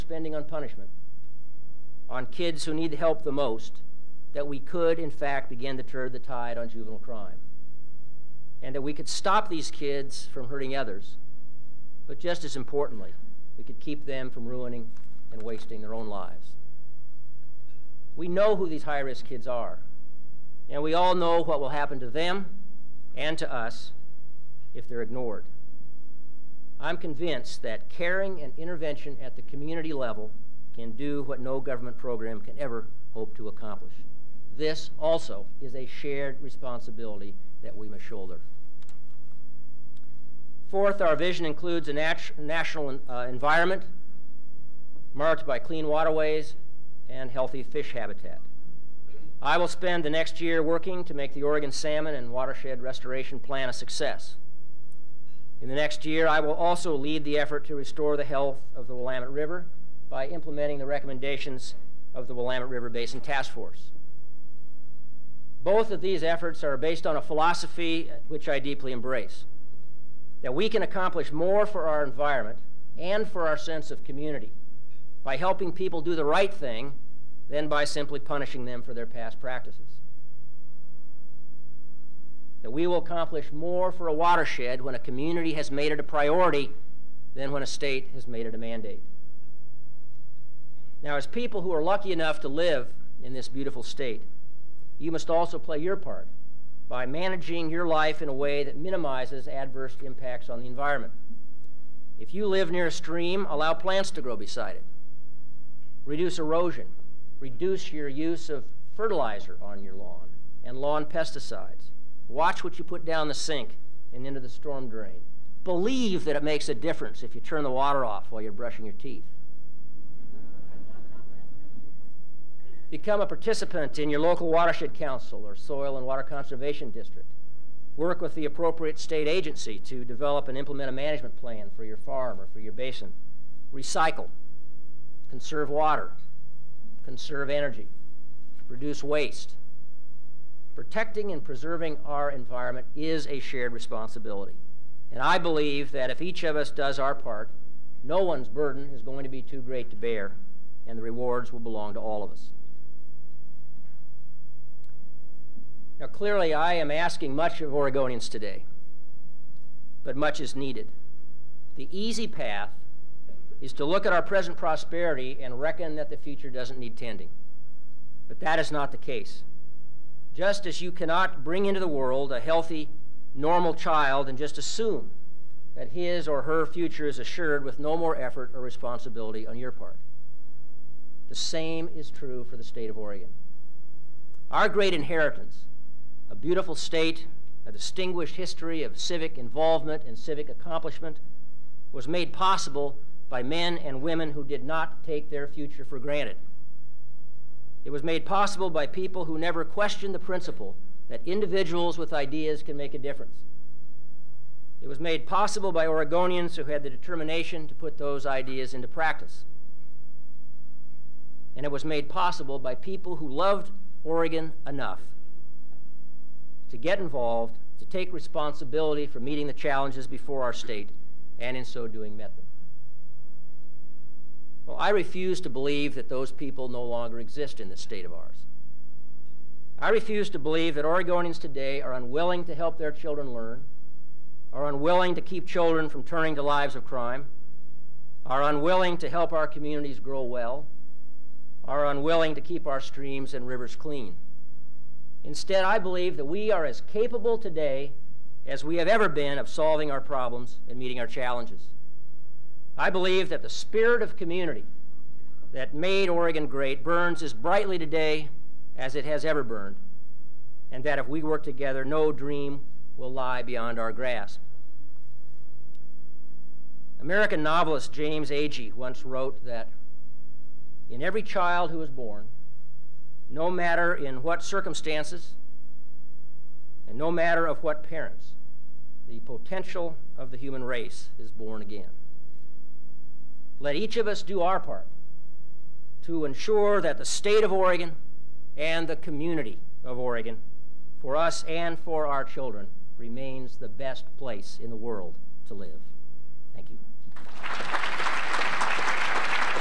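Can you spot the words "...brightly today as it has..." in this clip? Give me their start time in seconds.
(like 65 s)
257 s.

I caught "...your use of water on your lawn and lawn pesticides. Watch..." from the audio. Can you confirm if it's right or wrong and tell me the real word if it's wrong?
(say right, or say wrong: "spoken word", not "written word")
wrong: "fertilizer", not "water".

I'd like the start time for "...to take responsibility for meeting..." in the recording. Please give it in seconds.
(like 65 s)
217 s.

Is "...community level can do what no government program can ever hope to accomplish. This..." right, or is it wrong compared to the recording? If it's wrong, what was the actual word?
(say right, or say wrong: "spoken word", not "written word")
right.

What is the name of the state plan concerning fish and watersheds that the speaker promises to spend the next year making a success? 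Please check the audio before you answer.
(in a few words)
Oregon Salmon and Watershed Restoration Plan.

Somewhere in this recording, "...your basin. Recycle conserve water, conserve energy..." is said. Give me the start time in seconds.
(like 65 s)
132 s.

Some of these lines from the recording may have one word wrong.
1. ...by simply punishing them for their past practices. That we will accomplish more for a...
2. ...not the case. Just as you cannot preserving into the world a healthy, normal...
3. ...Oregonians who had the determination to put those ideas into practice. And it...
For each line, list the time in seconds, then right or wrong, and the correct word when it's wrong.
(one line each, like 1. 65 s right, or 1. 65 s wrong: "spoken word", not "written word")
1. 77 s right
2. 168 s wrong: "bring", not "preserving"
3. 205 s right.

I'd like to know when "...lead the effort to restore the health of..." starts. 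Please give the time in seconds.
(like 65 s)
56 s.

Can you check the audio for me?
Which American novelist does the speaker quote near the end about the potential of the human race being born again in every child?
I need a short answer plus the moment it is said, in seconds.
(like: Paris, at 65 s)
James Agee, at 267 s.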